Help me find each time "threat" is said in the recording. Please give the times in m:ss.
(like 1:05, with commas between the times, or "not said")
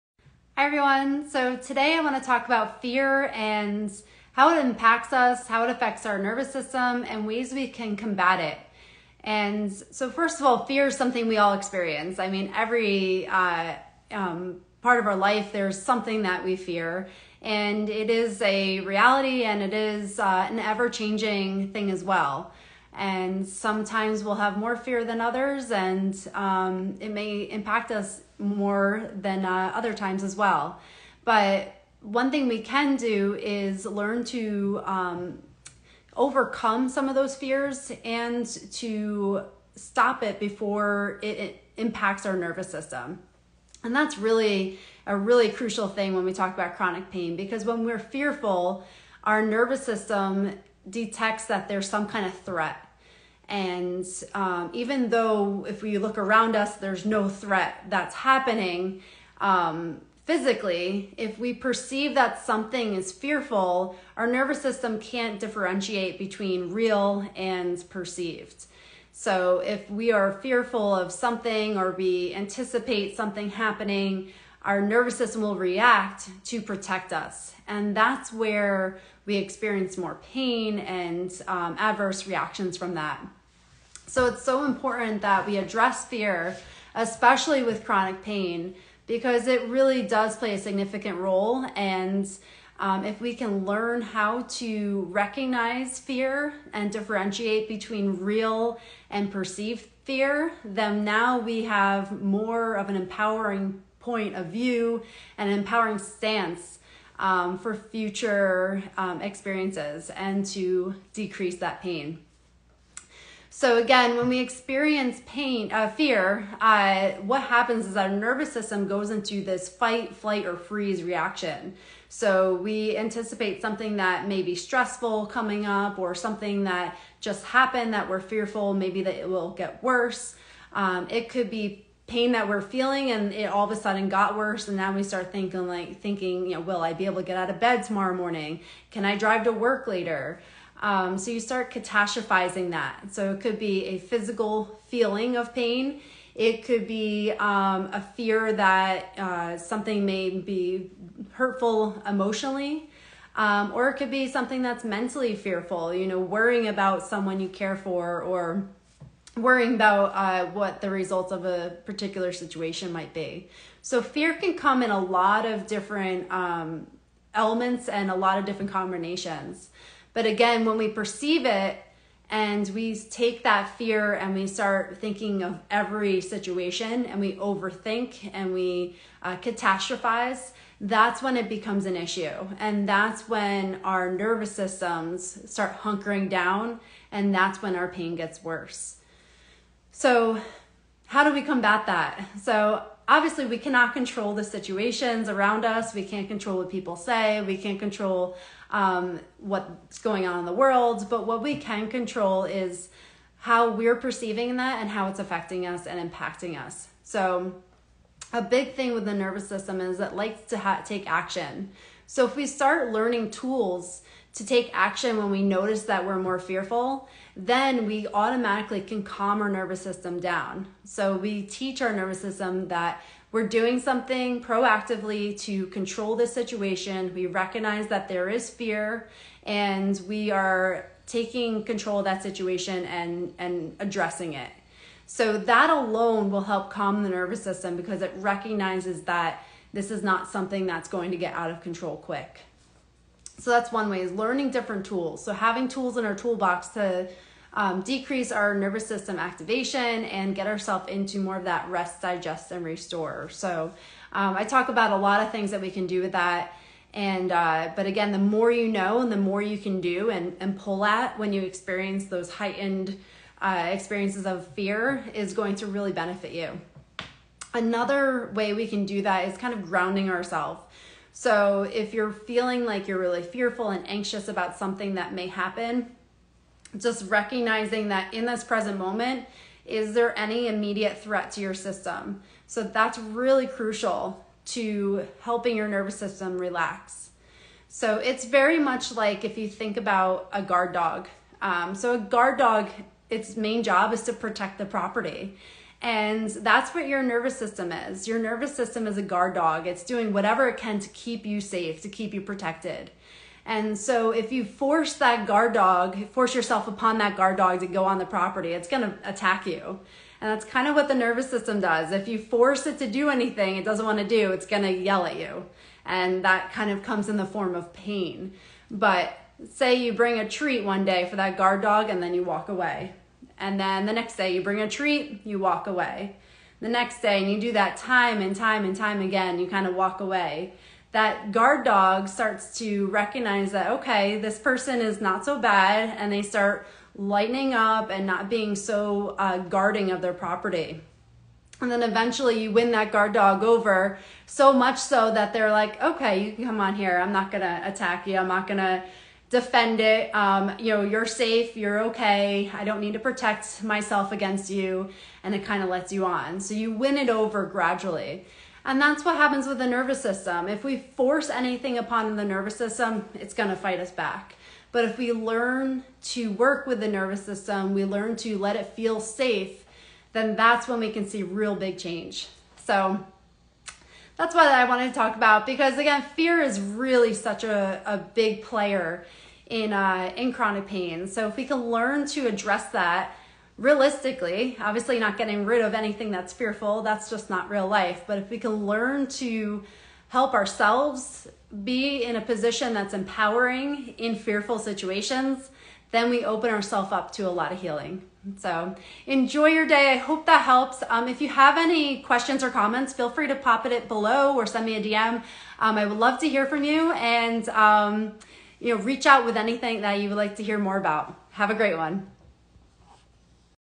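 0:52, 0:57, 4:40.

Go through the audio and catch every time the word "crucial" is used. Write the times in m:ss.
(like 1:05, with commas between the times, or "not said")
0:45, 4:43.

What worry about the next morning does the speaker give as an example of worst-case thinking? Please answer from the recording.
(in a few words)
Get out of bed.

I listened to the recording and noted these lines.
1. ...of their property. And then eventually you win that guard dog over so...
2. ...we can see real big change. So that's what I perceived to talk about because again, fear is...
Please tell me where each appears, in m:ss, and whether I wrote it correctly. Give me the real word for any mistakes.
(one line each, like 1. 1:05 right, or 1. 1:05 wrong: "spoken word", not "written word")
1. 5:39 right
2. 6:10 wrong: "wanted", not "perceived".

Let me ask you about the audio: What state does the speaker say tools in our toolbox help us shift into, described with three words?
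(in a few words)
Rest, digest, and restore.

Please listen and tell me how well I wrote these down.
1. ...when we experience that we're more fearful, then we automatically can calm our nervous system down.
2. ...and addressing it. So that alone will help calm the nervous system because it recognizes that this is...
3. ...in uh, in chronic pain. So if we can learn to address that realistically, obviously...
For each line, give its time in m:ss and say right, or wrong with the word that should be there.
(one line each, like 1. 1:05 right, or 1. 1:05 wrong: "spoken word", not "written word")
1. 3:35 wrong: "notice", not "experience"
2. 3:53 right
3. 6:19 right.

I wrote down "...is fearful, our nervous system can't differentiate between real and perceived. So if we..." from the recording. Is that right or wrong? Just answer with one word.
right.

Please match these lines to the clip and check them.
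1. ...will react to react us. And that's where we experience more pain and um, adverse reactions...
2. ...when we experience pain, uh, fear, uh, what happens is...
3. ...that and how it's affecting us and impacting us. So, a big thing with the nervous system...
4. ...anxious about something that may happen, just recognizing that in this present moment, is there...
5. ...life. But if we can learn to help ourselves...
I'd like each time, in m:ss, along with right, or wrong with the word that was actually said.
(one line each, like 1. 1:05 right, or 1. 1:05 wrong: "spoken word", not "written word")
1. 1:15 wrong: "protect", not "react"
2. 1:54 right
3. 3:24 right
4. 4:33 right
5. 6:27 right.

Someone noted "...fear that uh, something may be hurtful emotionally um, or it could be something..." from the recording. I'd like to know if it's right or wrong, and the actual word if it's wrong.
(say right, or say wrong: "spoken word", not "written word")
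right.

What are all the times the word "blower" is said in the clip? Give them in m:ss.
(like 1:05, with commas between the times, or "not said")
not said.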